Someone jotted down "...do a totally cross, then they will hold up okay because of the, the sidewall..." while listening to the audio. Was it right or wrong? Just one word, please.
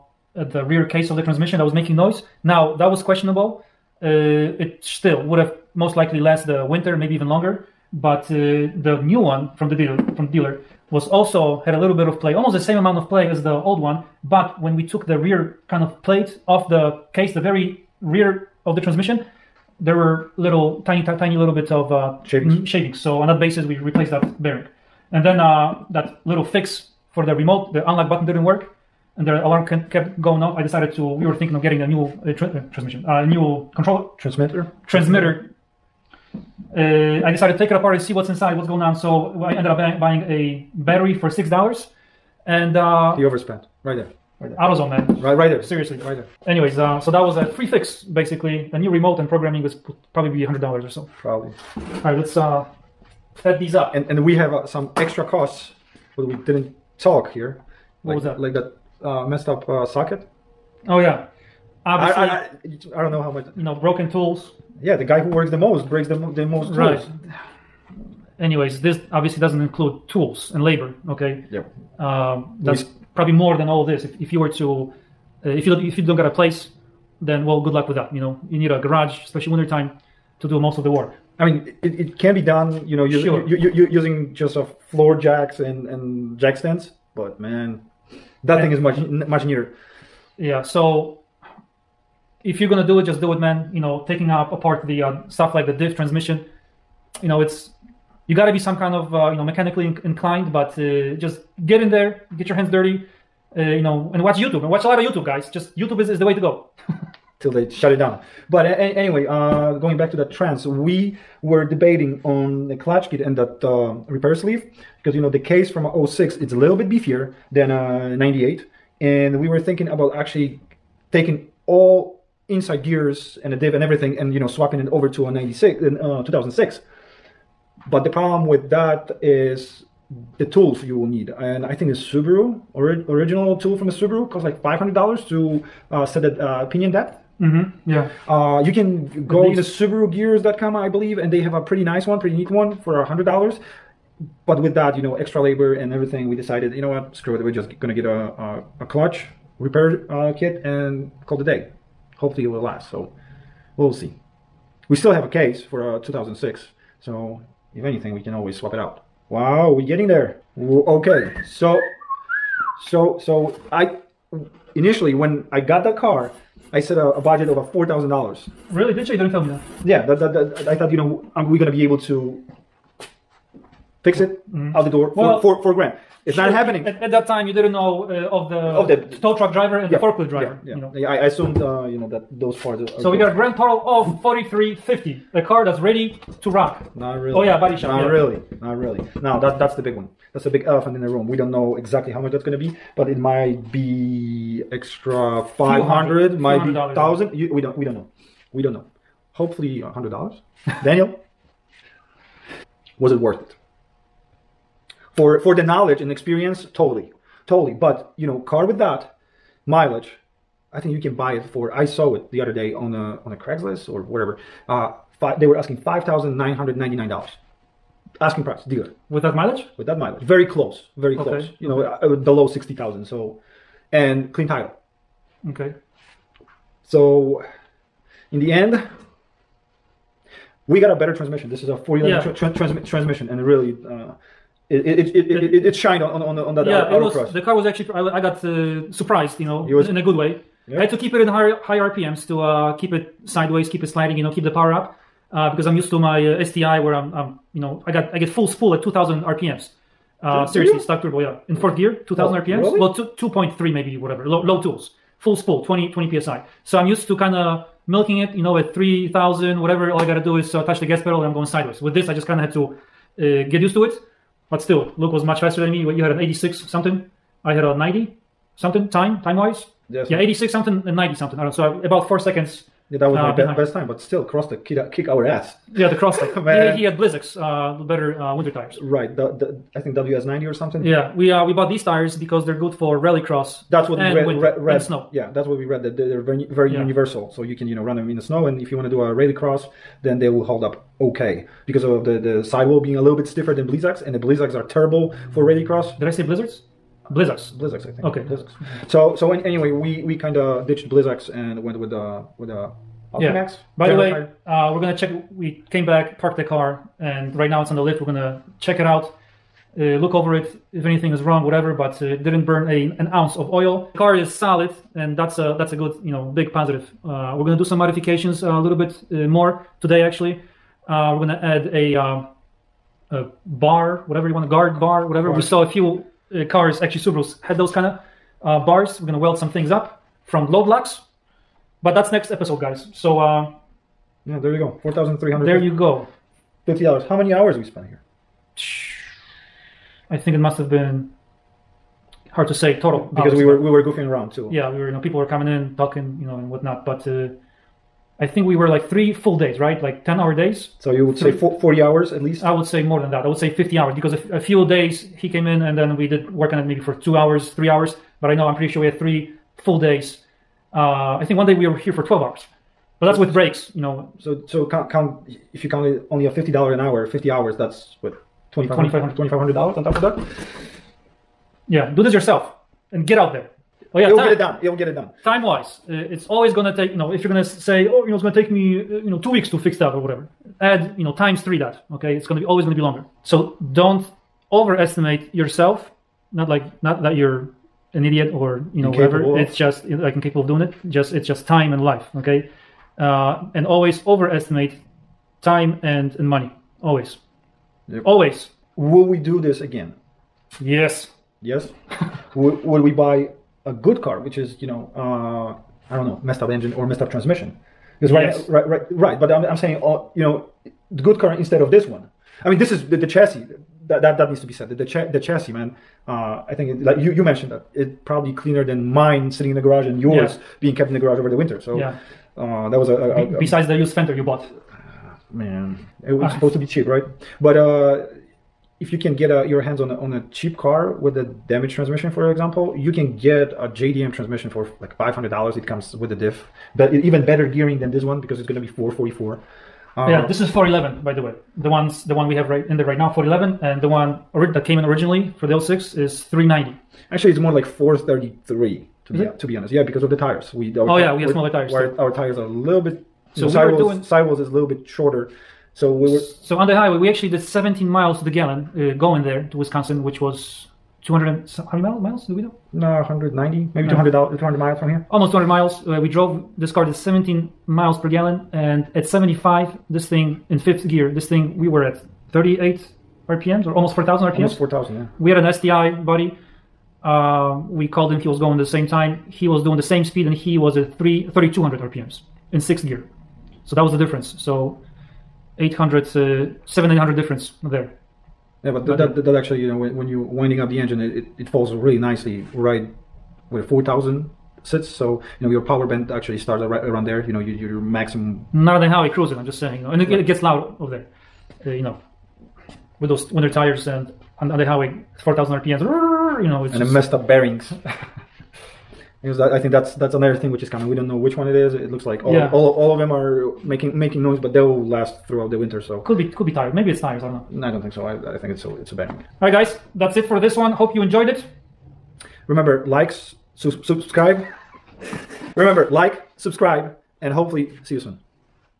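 wrong.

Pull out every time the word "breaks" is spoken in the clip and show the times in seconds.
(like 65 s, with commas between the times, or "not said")
65 s, 363 s.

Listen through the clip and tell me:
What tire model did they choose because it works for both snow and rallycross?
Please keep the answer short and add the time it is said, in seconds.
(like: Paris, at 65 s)
Altimax, at 303 s.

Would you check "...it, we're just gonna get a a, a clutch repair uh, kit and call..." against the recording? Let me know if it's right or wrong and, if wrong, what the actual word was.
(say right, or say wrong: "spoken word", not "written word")
right.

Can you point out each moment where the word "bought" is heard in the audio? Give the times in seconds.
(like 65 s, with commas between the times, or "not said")
281 s, 424 s.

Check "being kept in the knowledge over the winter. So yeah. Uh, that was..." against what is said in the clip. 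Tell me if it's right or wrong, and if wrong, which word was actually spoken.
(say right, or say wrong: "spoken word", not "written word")
wrong: "garage", not "knowledge".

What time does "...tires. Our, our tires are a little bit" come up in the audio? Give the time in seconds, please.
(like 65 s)
451 s.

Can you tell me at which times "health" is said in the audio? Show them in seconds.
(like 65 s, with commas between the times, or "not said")
not said.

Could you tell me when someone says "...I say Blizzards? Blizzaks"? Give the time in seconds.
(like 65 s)
296 s.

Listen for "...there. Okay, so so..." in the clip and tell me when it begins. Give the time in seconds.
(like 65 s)
160 s.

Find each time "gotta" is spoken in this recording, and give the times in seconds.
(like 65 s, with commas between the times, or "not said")
98 s, 260 s.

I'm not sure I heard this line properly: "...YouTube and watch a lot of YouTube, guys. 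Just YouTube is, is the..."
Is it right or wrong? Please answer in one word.
right.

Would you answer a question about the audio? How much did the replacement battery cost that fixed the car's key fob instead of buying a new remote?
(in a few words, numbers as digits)
$6.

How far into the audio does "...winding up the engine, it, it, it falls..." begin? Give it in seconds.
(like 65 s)
490 s.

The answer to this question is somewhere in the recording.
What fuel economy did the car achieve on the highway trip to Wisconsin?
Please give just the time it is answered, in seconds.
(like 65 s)
457 s.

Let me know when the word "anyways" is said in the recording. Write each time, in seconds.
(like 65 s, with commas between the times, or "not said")
46 s, 68 s, 108 s, 299 s.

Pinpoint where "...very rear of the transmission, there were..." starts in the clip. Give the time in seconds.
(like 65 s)
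17 s.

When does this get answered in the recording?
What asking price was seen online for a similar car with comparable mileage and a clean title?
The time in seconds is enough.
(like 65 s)
215 s.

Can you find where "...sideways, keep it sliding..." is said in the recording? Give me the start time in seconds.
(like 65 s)
243 s.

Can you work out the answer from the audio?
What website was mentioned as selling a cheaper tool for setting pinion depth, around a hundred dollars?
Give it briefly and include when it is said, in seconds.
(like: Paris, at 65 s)
SubaruGears.com, at 139 s.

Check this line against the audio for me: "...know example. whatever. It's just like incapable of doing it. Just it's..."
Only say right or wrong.
wrong.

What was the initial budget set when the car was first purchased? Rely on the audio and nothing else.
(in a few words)
$4,000.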